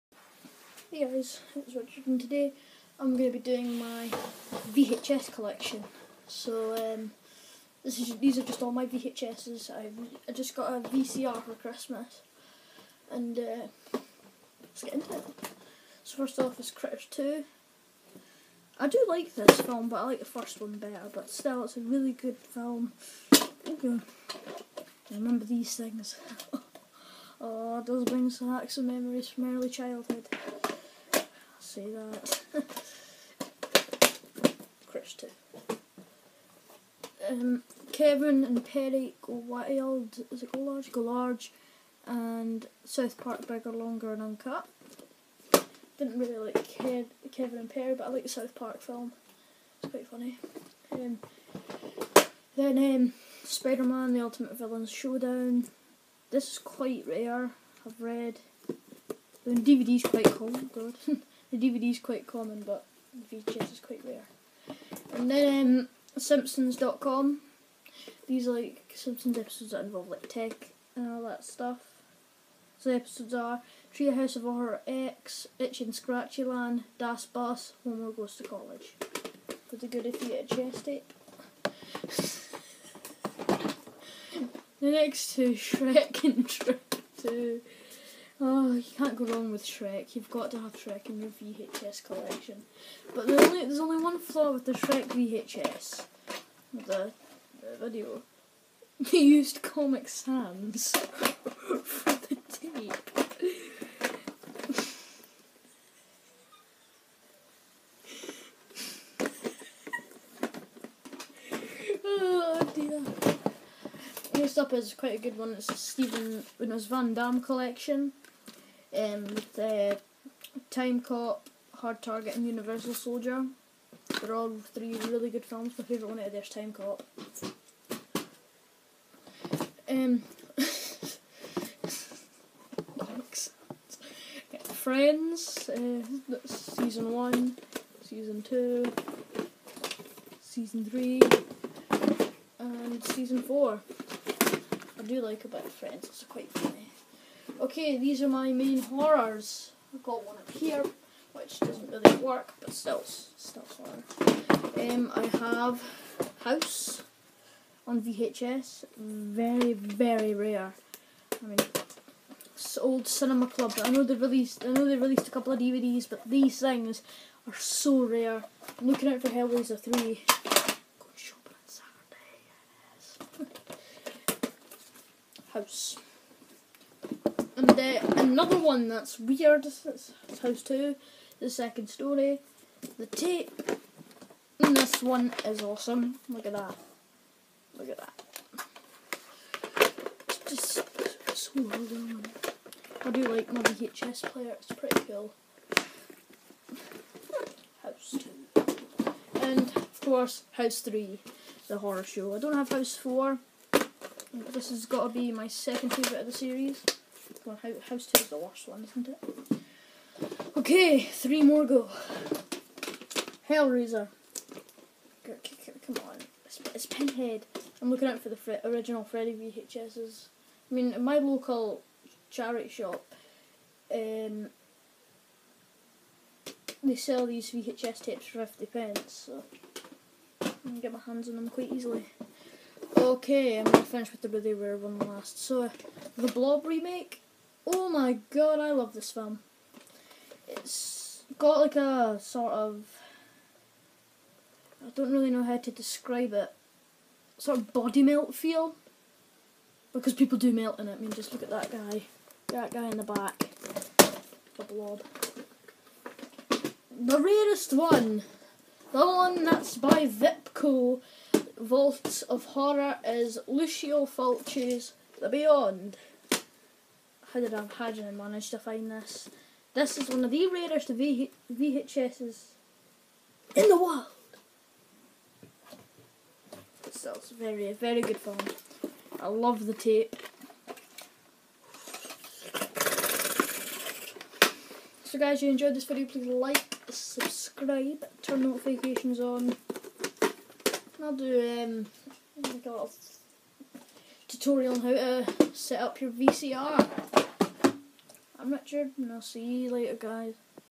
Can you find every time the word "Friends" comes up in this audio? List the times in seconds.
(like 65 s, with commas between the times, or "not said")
134 s, 145 s.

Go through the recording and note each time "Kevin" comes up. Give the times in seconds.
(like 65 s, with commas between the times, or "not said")
37 s, 47 s.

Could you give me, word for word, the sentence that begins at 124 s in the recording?
They're all three really good films.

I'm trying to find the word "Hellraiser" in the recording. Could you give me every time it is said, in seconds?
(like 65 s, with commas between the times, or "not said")
169 s, 213 s.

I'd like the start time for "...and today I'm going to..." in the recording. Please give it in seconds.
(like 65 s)
2 s.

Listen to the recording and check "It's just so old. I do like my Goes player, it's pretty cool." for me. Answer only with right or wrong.
wrong.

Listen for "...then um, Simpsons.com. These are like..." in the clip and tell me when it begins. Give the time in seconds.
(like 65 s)
65 s.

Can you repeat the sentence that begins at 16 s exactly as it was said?
So first off is Critters 2.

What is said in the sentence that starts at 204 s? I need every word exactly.
This has got to be my second favourite of the series.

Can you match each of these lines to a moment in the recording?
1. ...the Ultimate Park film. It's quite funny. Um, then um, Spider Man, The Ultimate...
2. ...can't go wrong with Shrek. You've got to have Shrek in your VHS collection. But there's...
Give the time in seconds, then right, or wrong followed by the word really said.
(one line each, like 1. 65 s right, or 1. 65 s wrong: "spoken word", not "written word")
1. 48 s wrong: "South", not "Ultimate"
2. 88 s right.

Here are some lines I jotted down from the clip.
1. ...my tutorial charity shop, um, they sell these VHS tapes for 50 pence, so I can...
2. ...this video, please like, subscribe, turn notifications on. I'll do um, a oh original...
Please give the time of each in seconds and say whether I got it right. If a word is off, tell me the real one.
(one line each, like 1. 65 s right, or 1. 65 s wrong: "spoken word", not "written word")
1. 221 s wrong: "local", not "tutorial"
2. 285 s wrong: "tutorial", not "original".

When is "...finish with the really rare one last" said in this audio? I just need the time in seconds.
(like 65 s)
233 s.